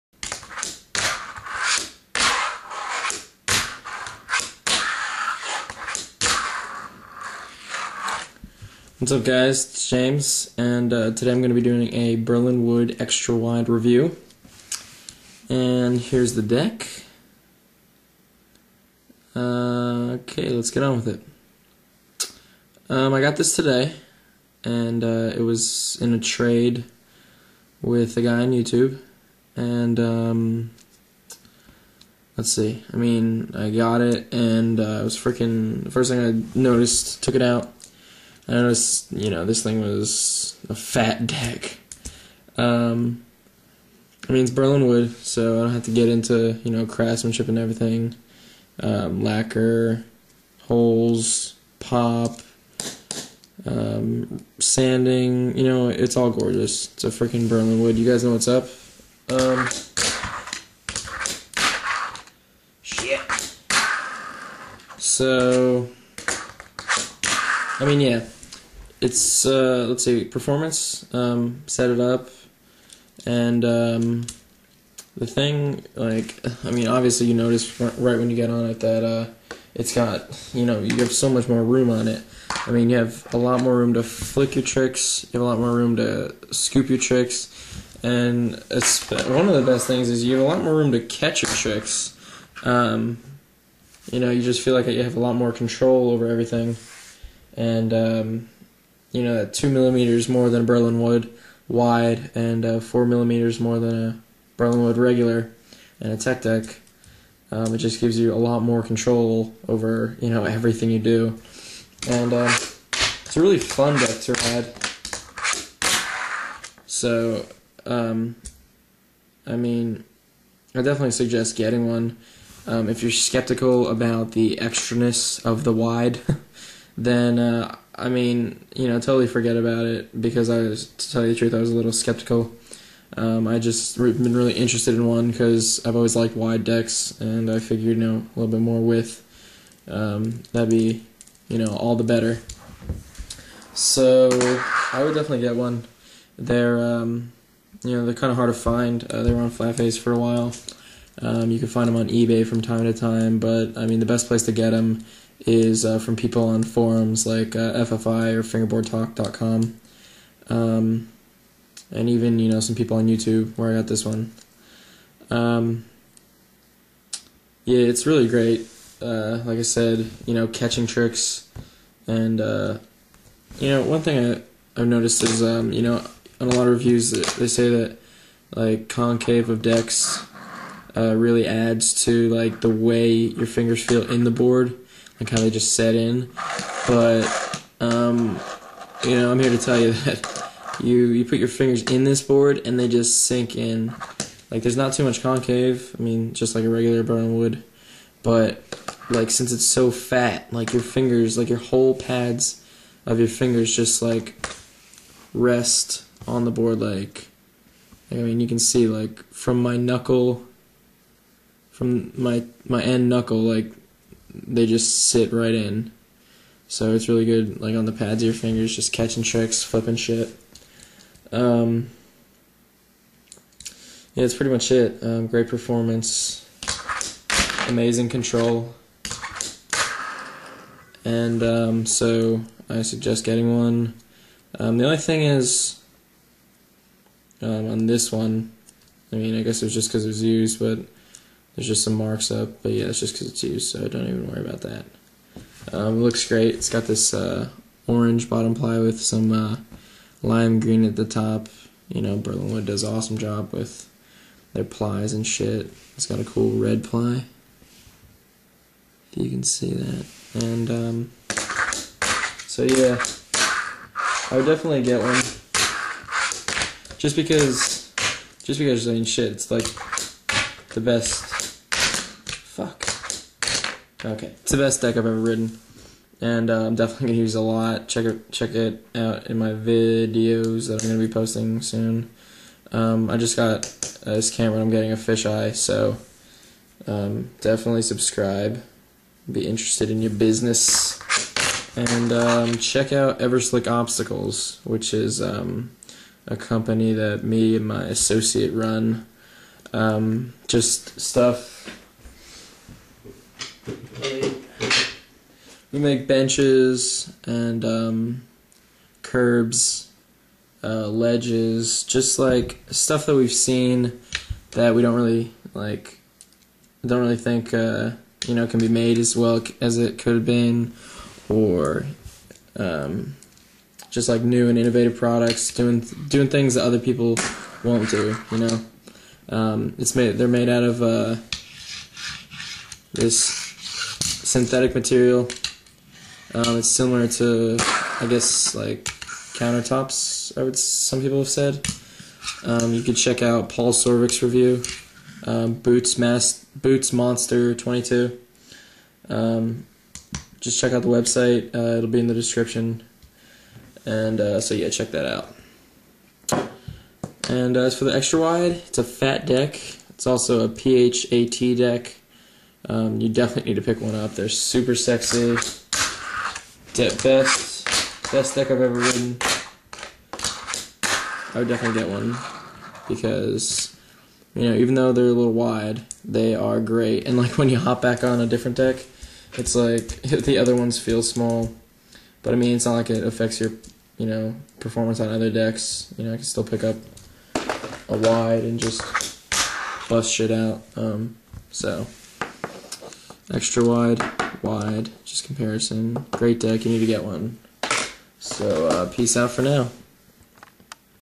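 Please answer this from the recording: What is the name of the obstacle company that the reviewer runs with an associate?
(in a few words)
Everslick Obstacles.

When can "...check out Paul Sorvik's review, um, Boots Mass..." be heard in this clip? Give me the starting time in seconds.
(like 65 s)
342 s.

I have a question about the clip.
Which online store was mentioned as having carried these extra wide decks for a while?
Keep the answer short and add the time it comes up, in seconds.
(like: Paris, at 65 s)
Flatface, at 149 s.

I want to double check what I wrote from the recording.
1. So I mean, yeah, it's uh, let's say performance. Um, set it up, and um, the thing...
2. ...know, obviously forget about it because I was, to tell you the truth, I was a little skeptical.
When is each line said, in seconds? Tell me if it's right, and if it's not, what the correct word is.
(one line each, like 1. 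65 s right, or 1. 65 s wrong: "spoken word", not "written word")
1. 64 s right
2. 128 s wrong: "totally", not "obviously".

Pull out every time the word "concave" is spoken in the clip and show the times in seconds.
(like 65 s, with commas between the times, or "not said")
178 s, 195 s.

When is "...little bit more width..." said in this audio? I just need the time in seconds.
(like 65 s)
138 s.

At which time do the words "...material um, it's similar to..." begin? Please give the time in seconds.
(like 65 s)
334 s.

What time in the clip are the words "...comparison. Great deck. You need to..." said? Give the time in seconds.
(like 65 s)
395 s.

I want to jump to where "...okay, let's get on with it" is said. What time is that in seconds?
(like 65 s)
20 s.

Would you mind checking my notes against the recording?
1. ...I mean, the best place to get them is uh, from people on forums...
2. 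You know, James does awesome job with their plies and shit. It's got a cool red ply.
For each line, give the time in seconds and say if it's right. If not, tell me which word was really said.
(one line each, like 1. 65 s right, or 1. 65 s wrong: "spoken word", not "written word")
1. 153 s right
2. 251 s wrong: "Berlinwood", not "James".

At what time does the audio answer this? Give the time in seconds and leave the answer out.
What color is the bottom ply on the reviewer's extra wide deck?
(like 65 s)
247 s.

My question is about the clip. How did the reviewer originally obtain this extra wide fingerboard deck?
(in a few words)
In a trade.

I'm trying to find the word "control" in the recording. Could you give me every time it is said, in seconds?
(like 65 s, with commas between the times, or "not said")
95 s, 108 s, 228 s.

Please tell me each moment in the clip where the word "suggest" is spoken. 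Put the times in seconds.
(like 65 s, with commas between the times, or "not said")
121 s, 232 s.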